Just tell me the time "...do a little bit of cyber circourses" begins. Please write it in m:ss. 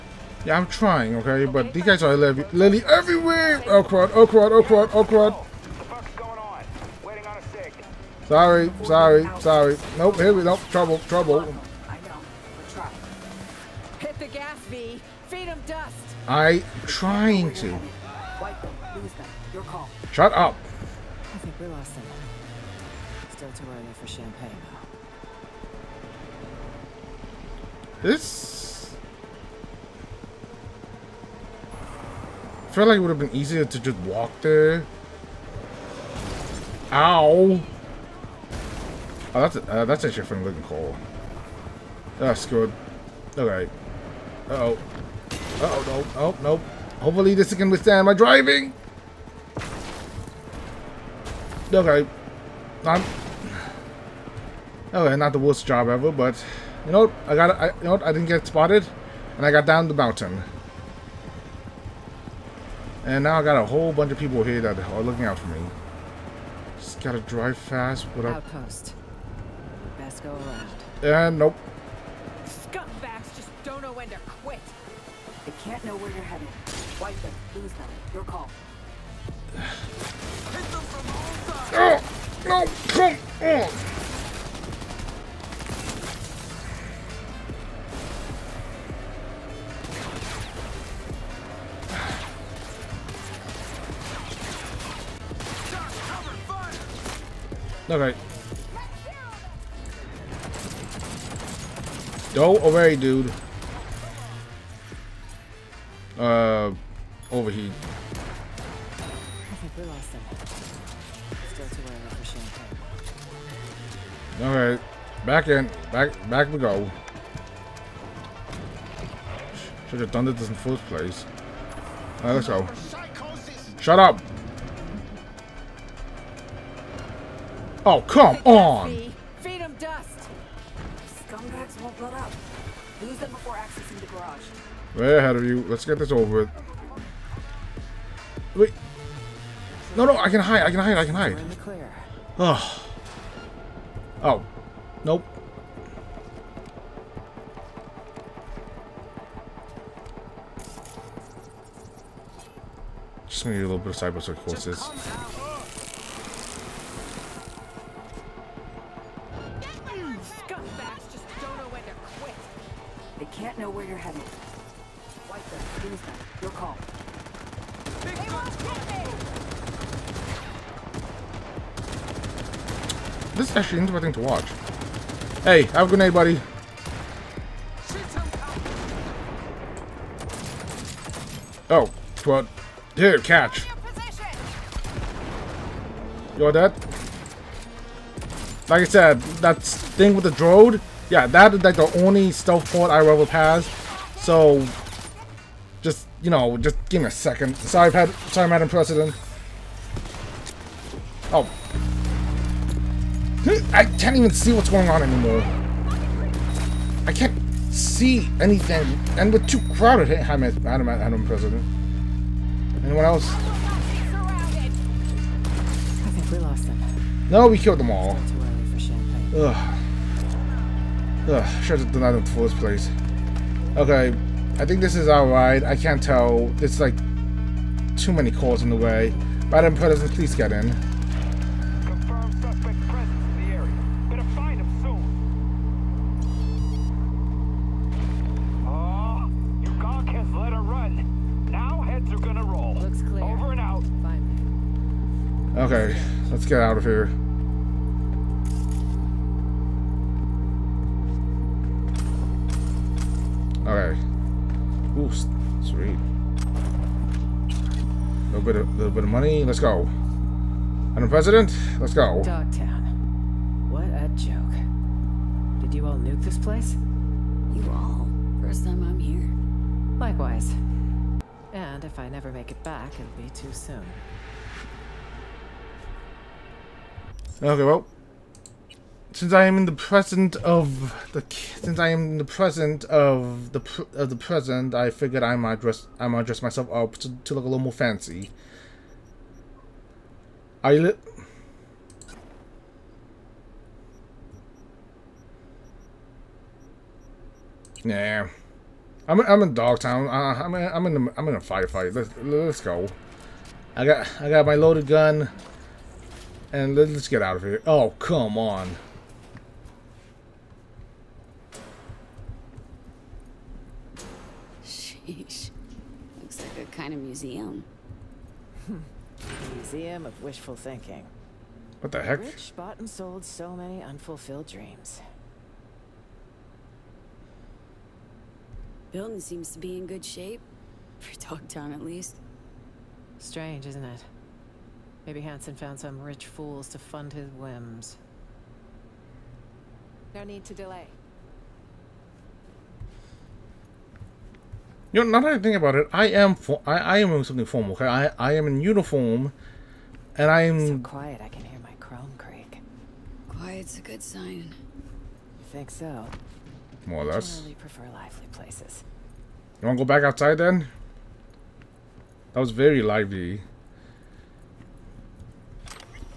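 2:33.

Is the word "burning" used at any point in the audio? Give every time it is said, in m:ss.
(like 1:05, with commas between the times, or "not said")
not said.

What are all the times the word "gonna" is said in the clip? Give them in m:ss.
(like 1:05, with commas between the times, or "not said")
2:33, 4:02.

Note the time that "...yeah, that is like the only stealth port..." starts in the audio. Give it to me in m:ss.
3:11.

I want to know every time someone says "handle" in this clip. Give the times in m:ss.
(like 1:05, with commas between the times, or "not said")
not said.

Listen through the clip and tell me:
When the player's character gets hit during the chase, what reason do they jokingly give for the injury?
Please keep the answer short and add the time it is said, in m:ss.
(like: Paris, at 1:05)
Looking cool, at 0:40.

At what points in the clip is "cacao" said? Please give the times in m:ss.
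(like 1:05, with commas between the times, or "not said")
not said.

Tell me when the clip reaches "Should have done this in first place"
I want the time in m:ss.
1:59.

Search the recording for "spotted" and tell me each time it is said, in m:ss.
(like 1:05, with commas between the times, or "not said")
0:58.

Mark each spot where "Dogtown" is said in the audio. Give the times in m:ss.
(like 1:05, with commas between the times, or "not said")
4:22, 4:59, 5:31.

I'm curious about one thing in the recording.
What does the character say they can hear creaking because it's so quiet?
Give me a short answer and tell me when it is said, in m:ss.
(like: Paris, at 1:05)
Chrome, at 5:51.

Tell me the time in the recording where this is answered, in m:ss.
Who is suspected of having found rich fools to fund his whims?
5:35.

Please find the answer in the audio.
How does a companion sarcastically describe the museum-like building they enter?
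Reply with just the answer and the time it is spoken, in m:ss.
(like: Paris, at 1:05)
Museum of wishful thinking, at 5:19.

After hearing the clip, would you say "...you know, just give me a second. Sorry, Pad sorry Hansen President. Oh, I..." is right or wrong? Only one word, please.
wrong.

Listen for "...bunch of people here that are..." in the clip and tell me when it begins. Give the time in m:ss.
1:03.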